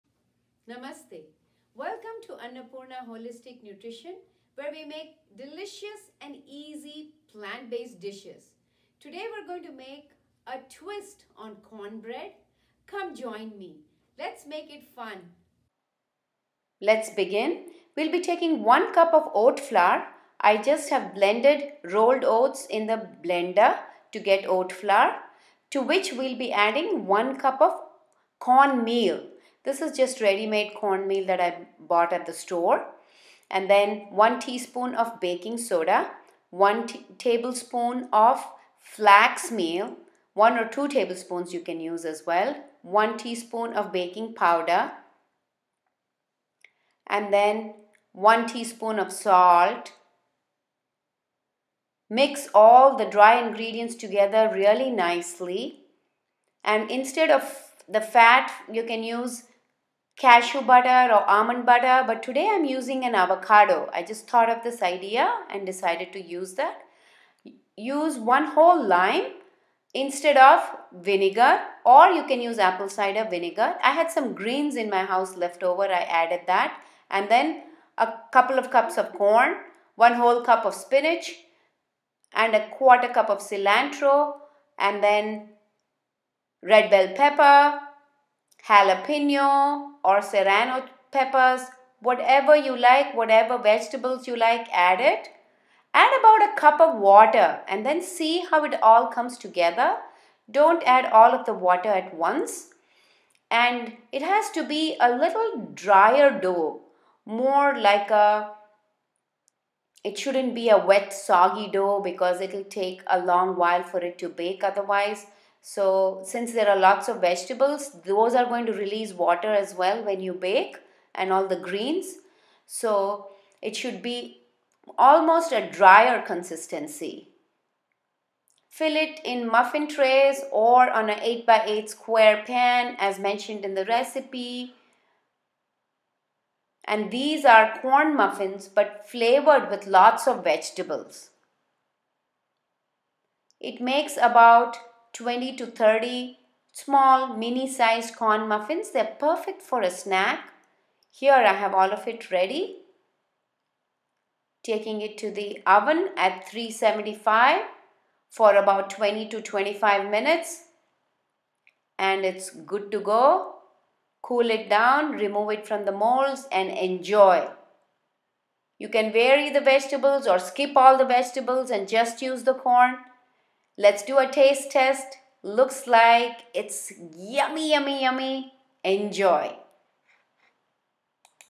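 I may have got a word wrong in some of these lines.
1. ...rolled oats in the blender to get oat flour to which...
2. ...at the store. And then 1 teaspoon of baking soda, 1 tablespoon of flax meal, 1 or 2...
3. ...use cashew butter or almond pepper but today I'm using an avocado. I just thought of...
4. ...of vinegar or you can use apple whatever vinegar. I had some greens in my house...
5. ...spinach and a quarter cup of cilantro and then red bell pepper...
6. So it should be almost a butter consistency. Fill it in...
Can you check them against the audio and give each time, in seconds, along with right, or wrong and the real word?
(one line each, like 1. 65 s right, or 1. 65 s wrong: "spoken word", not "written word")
1. 21 s right
2. 32 s right
3. 59 s wrong: "butter", not "pepper"
4. 70 s wrong: "cider", not "whatever"
5. 80 s right
6. 122 s wrong: "drier", not "butter".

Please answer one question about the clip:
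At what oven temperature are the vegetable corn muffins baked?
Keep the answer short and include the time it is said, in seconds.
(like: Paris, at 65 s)
375, at 156 s.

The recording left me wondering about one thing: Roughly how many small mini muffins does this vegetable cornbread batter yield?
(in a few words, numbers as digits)
20 to 30.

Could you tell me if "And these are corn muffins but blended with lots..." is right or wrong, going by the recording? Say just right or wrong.
wrong.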